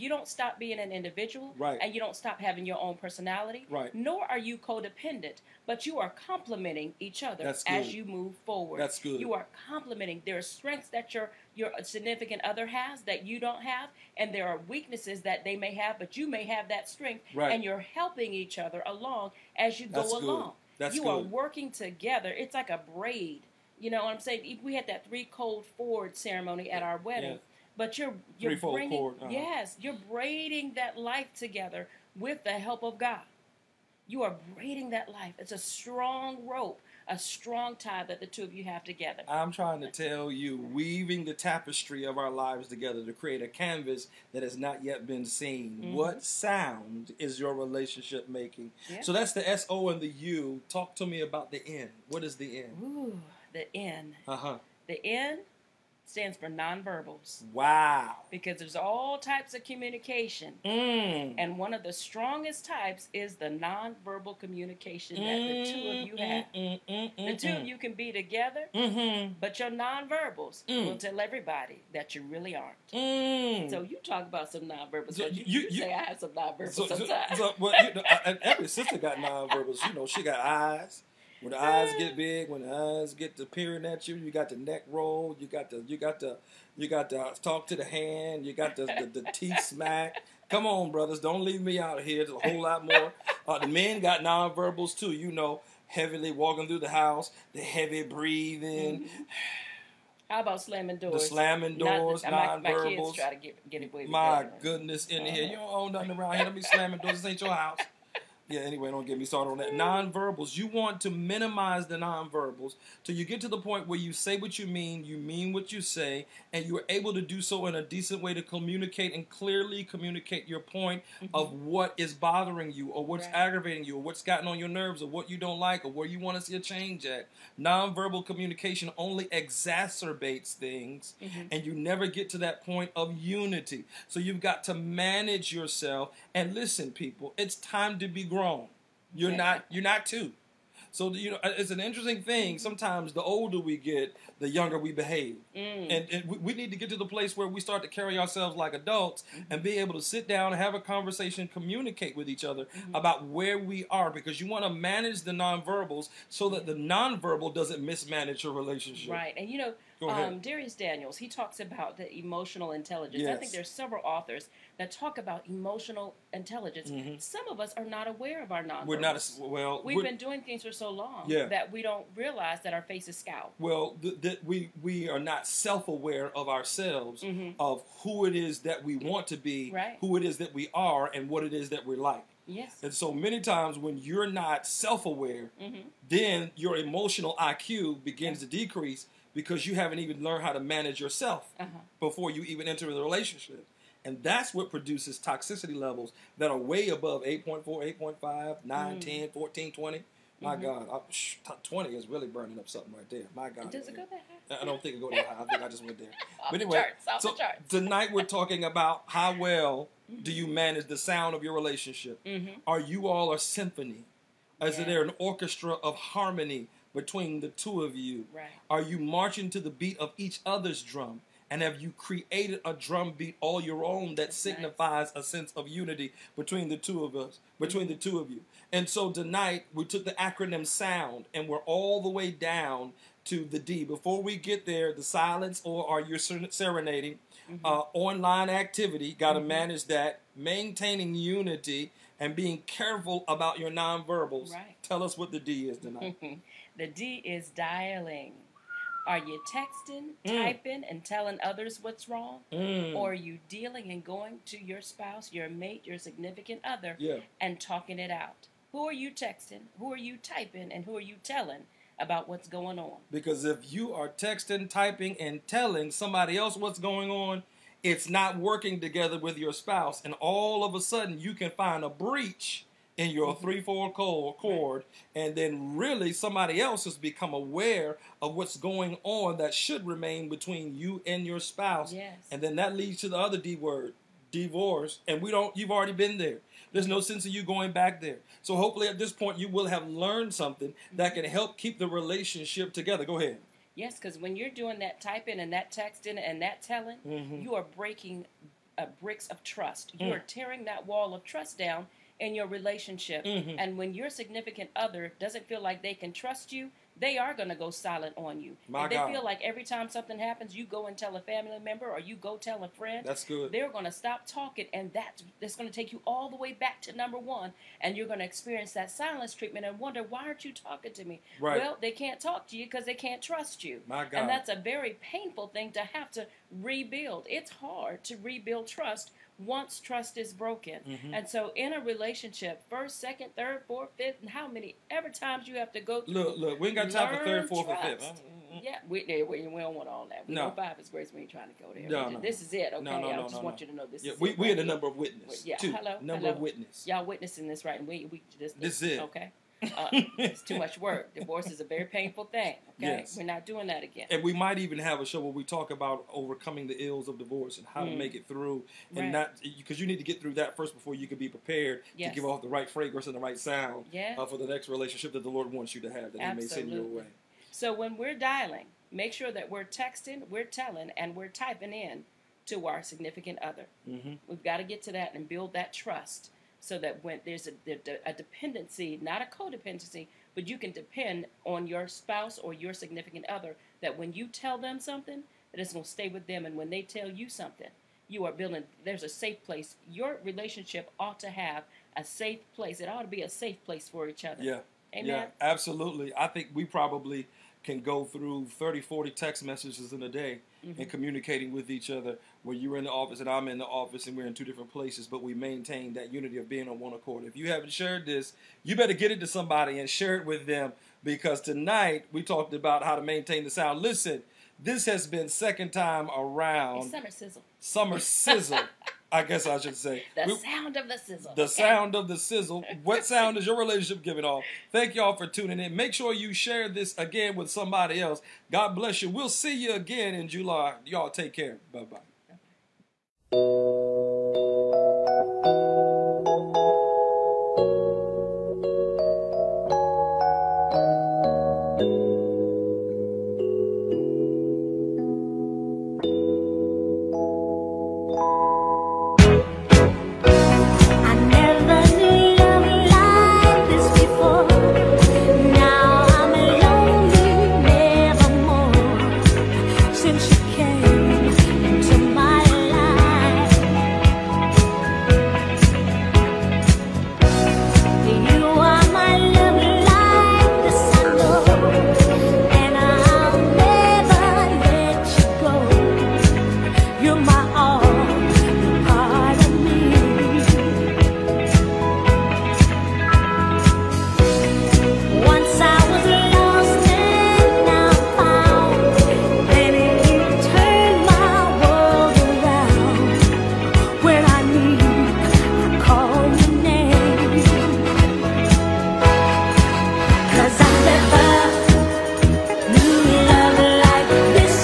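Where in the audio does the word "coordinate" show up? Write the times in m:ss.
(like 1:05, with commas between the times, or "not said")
not said.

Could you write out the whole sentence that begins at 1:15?
So you, you, you, you, say I have some nonverbals so, sometimes.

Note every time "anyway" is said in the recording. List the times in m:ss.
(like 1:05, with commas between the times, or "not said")
1:48, 3:26.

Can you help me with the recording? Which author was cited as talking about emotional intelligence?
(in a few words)
Darius Daniels.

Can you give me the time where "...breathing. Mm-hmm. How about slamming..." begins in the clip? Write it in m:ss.
1:38.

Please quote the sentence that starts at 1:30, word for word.
Come on, brothers, don't leave me out here.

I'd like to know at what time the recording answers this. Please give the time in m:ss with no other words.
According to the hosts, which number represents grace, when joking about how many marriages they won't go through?
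5:40.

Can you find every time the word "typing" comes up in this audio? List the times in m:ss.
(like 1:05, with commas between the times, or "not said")
4:10, 4:20, 4:24, 4:54, 6:11.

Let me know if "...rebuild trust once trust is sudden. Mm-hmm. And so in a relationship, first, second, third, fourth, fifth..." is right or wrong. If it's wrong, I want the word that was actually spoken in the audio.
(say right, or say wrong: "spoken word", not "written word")
wrong: "broken", not "sudden".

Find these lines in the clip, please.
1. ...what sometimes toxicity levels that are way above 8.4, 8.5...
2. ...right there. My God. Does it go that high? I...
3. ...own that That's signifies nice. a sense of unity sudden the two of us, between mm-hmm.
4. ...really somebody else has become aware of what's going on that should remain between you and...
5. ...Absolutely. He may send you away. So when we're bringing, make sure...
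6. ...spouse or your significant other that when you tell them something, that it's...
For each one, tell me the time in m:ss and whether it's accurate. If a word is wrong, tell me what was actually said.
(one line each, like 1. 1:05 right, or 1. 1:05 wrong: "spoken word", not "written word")
1. 3:14 wrong: "produces", not "sometimes"
2. 3:22 right
3. 3:43 wrong: "between", not "sudden"
4. 4:35 right
5. 6:06 wrong: "dialing", not "bringing"
6. 6:21 right.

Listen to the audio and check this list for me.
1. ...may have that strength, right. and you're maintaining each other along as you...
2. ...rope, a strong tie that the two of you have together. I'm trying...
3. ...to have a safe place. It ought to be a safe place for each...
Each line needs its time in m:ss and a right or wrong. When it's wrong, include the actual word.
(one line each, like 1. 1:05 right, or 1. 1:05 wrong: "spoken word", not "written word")
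1. 0:16 wrong: "helping", not "maintaining"
2. 0:36 right
3. 6:31 right.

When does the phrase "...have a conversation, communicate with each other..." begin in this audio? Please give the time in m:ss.
2:30.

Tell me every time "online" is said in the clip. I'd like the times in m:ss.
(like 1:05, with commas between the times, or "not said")
3:57.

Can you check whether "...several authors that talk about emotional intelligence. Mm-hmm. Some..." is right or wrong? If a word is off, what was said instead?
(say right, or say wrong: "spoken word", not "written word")
right.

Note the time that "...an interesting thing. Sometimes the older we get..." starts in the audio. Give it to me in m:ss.
2:21.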